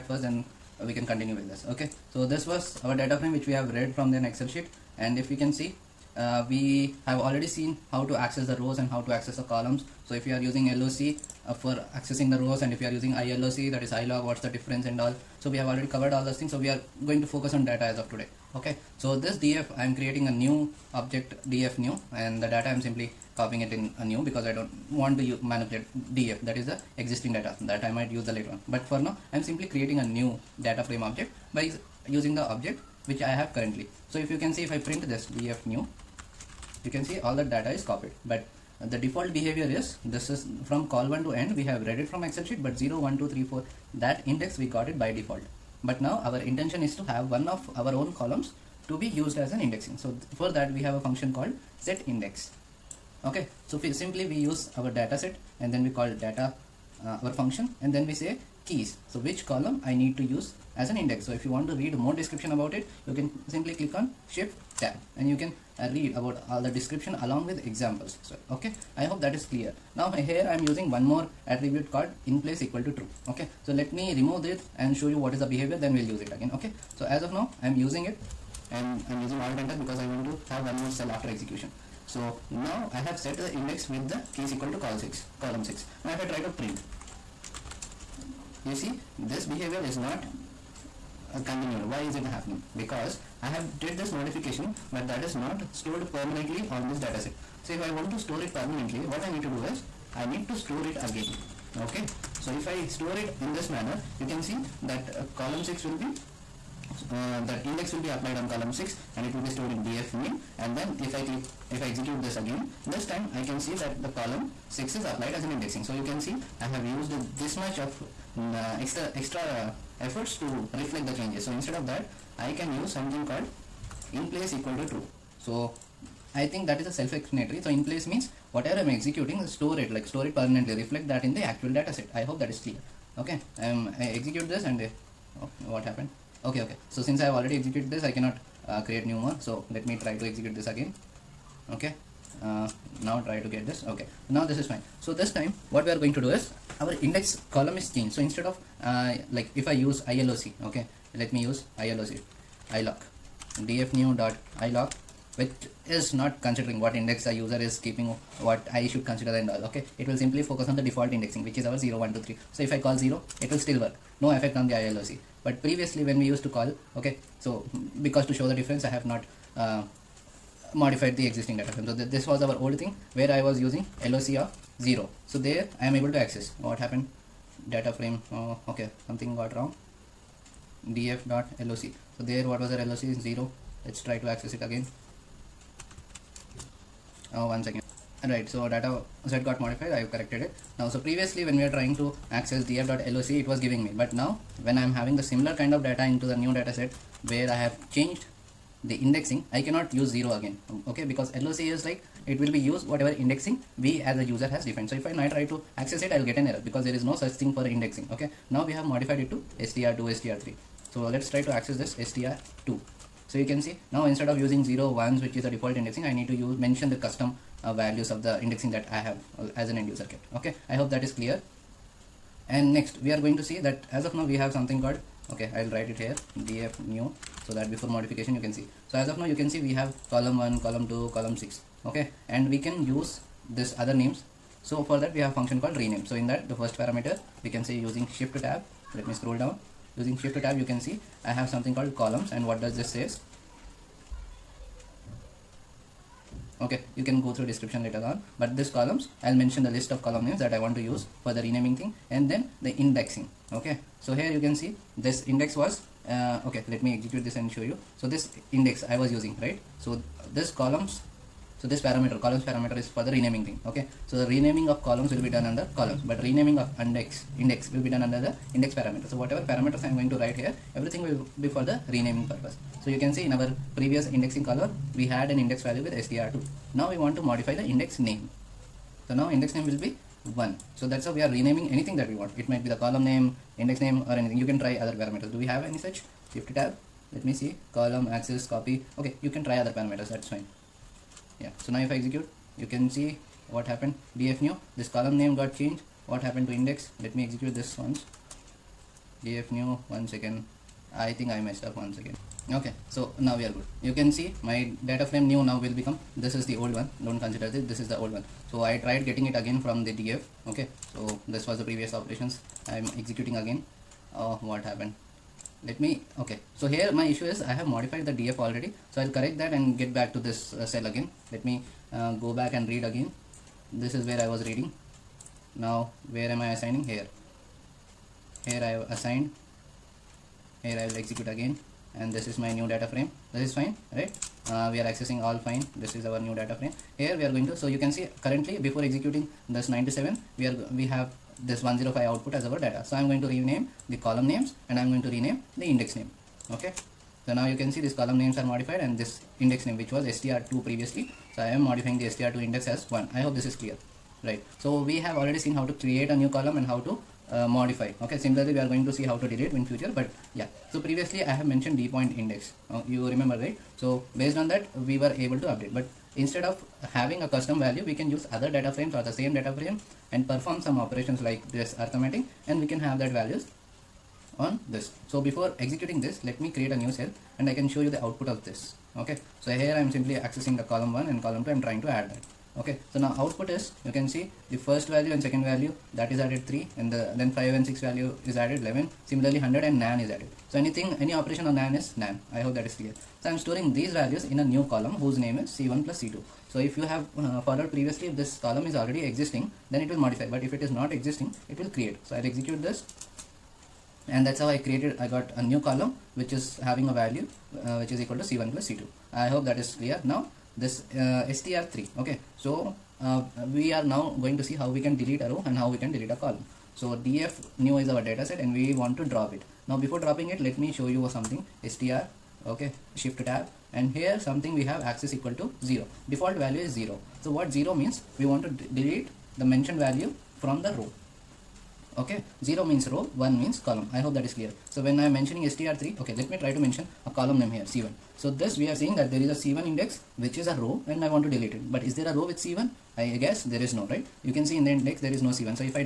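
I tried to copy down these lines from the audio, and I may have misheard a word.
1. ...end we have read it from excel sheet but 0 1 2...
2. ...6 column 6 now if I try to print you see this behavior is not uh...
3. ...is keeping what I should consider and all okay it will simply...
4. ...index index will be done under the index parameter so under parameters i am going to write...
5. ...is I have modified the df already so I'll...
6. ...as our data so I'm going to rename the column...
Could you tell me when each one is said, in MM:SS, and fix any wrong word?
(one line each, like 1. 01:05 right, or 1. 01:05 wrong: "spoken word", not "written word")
1. 00:41 right
2. 01:24 right
3. 02:37 right
4. 04:26 wrong: "whatever", not "under"
5. 05:17 right
6. 05:42 right.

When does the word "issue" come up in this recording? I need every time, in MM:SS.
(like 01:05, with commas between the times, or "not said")
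05:17.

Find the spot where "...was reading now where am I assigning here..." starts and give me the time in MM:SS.
05:24.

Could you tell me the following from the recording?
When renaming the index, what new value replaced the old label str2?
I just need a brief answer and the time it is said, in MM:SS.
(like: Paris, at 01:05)
1, at 04:39.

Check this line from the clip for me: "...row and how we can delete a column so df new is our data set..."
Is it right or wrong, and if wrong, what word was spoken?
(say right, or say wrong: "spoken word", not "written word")
right.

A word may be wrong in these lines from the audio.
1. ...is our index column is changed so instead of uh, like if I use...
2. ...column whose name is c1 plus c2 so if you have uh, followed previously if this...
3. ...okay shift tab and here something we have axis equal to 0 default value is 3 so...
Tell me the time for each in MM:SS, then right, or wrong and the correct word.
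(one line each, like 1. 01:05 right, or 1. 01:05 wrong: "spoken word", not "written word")
1. 02:26 right
2. 06:34 right
3. 07:02 wrong: "0", not "3".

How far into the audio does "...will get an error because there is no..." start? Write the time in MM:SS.
03:26.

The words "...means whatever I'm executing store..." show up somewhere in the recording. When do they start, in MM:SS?
02:08.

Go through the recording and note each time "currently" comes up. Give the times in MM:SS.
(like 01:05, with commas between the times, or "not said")
00:33, 05:38.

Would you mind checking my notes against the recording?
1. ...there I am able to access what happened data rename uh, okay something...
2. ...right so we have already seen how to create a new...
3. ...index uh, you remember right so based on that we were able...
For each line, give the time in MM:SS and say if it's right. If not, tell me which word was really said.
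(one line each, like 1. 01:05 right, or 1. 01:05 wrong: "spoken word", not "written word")
1. 02:55 wrong: "frame", not "rename"
2. 05:54 right
3. 06:02 right.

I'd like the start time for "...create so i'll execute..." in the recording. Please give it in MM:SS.
06:41.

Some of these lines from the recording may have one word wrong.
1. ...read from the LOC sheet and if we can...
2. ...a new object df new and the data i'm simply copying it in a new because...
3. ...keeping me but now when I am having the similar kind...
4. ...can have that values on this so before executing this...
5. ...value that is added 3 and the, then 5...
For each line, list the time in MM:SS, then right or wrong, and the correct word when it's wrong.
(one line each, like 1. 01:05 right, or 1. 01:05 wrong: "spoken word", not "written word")
1. 00:03 wrong: "Excel", not "LOC"
2. 00:20 right
3. 03:13 wrong: "giving", not "keeping"
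4. 06:12 right
5. 06:25 right.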